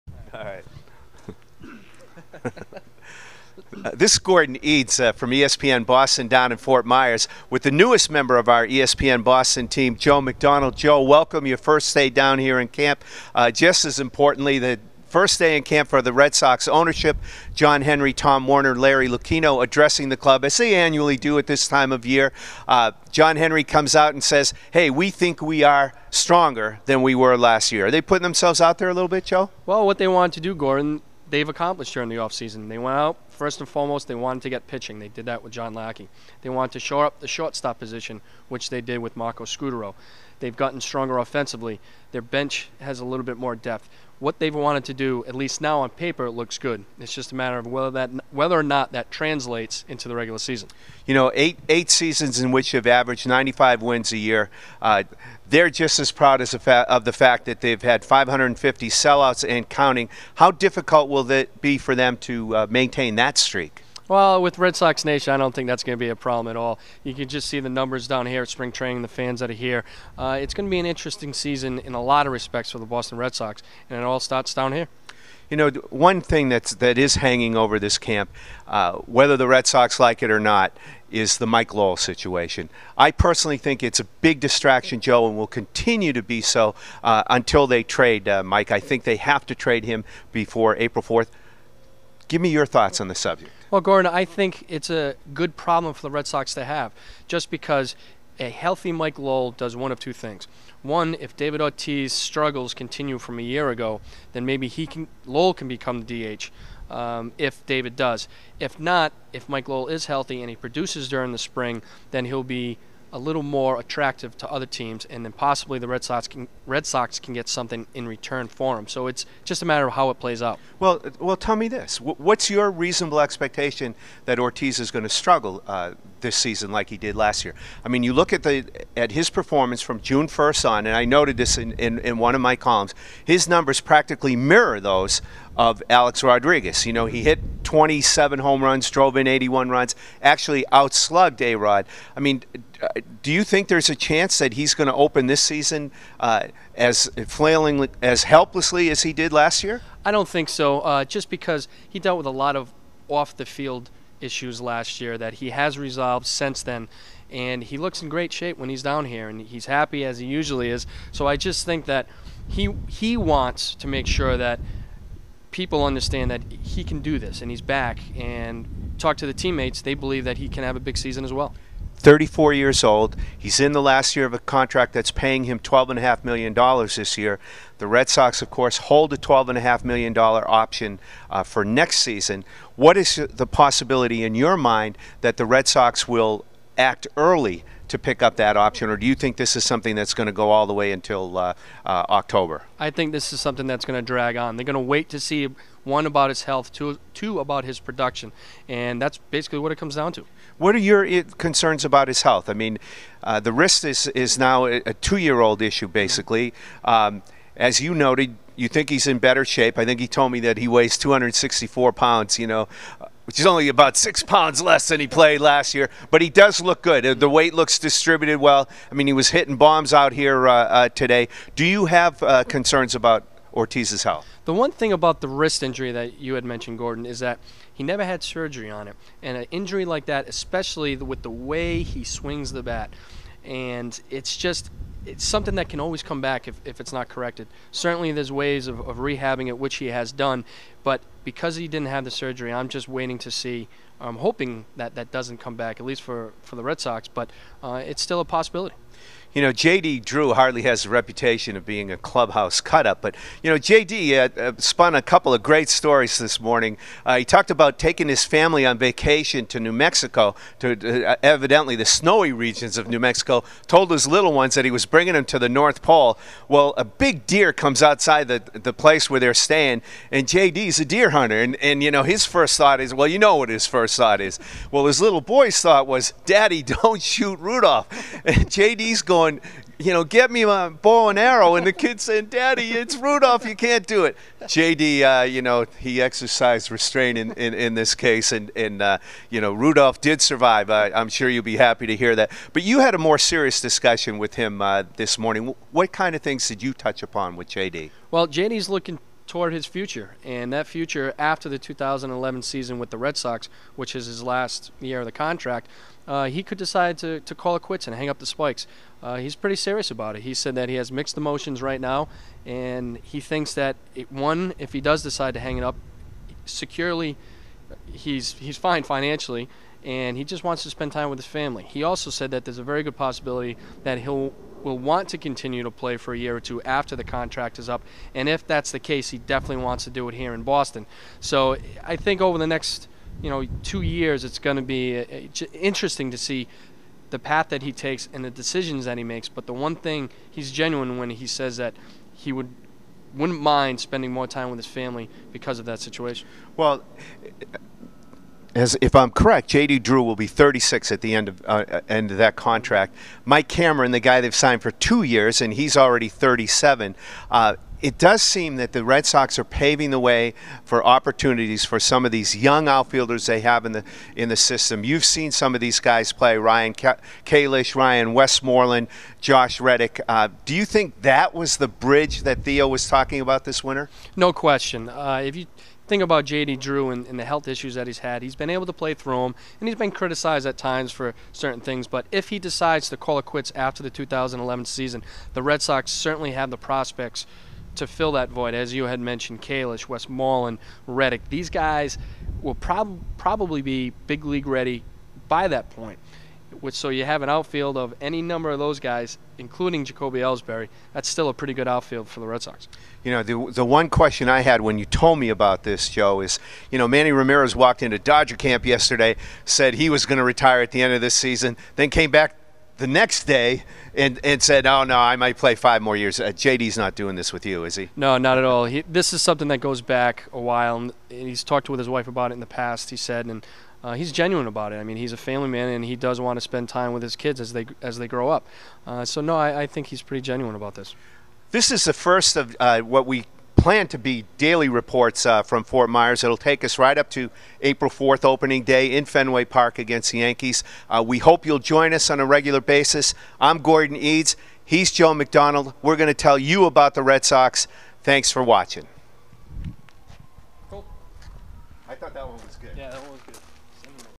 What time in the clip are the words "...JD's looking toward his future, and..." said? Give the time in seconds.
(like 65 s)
298 s.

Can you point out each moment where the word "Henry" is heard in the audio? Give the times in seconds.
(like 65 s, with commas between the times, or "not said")
17 s, 23 s.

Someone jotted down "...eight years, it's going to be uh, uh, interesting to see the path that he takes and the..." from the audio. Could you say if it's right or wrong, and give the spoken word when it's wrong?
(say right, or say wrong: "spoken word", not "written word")
wrong: "two", not "eight".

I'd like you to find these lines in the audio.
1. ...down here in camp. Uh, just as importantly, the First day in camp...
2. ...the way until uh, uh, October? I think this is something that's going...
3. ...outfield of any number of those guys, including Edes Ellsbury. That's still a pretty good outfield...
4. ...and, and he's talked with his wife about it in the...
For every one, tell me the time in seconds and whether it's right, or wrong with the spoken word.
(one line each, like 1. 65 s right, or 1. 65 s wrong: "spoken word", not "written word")
1. 12 s right
2. 190 s right
3. 397 s wrong: "Jacoby", not "Edes"
4. 420 s right.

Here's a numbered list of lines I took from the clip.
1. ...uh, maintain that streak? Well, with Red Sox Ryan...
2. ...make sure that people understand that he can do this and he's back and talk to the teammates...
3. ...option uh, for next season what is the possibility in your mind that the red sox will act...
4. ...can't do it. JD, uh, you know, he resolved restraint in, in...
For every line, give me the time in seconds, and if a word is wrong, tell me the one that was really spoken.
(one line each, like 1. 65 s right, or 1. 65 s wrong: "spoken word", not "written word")
1. 62 s wrong: "Nation", not "Ryan"
2. 163 s right
3. 180 s right
4. 283 s wrong: "exercised", not "resolved".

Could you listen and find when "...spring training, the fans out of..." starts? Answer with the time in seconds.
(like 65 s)
68 s.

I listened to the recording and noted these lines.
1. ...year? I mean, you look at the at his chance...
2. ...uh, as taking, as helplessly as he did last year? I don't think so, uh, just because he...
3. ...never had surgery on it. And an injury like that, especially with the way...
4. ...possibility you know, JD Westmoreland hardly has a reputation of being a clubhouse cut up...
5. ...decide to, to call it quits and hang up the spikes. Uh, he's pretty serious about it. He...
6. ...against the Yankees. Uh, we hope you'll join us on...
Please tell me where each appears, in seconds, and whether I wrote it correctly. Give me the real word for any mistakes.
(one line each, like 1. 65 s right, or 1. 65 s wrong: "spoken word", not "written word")
1. 127 s wrong: "performance", not "chance"
2. 146 s wrong: "flailing", not "taking"
3. 227 s right
4. 248 s wrong: "Drew", not "Westmoreland"
5. 306 s right
6. 439 s right.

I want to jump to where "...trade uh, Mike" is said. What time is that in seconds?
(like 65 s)
87 s.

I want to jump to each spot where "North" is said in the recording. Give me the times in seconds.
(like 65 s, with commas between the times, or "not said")
265 s.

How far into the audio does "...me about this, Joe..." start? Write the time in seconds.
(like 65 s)
405 s.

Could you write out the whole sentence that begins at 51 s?
You know, eight eight seasons in which they've averaged 95 wins a year.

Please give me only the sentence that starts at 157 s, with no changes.
And he looks in great shape when he's down here, and he's happy as he usually is.